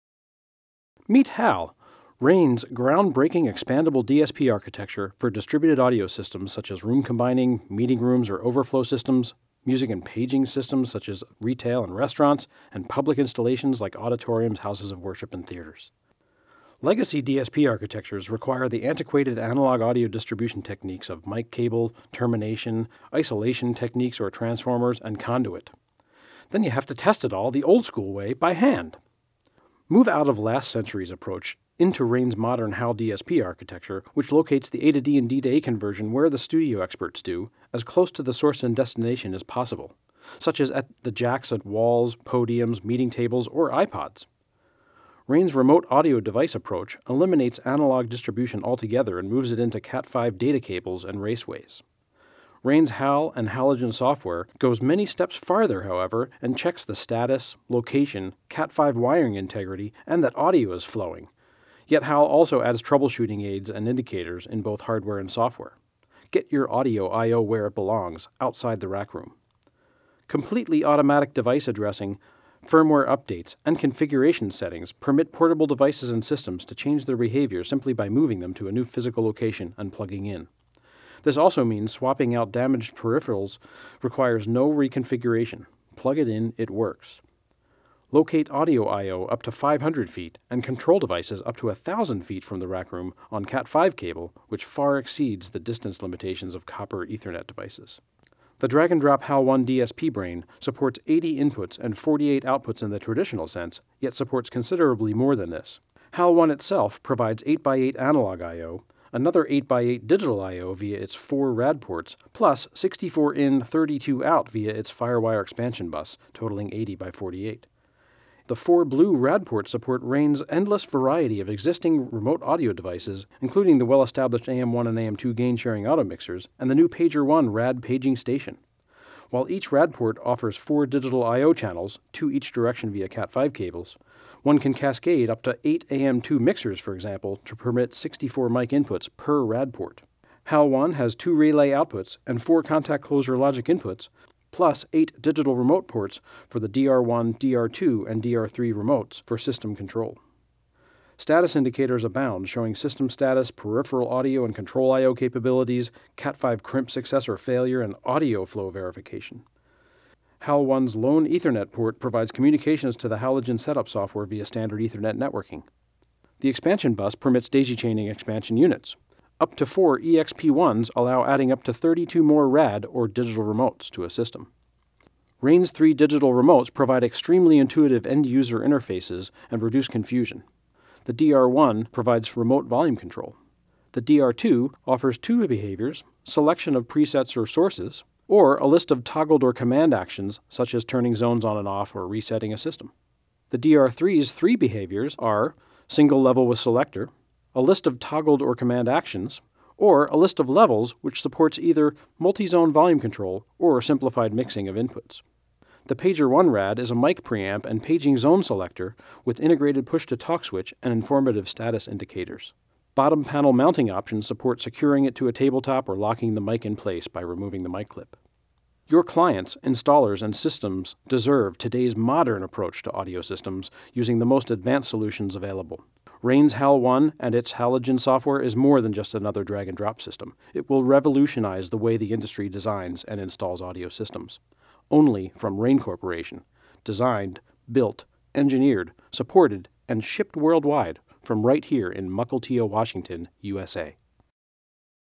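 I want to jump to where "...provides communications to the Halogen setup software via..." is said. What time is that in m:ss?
2:41.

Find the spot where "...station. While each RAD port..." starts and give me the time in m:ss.
2:08.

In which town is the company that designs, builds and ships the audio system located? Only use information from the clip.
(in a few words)
Mukilteo.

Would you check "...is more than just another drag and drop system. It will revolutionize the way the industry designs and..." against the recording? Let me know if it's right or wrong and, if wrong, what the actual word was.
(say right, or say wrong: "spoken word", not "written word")
right.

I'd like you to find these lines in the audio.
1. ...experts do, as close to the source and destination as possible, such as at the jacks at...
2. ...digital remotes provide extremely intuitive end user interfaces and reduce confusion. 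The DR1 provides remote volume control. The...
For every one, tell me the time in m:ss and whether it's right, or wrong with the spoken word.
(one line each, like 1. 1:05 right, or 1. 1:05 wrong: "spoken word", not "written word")
1. 0:36 right
2. 2:55 right.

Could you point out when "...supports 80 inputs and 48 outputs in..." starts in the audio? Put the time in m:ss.
1:40.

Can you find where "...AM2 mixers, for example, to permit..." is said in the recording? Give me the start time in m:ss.
2:15.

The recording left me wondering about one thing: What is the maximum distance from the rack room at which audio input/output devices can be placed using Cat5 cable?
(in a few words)
500 feet.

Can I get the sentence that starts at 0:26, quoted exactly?
Then you have to test it all the old school way by hand.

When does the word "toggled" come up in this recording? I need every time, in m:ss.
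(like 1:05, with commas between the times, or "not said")
3:09, 3:17.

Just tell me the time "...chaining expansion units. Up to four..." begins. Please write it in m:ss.
2:47.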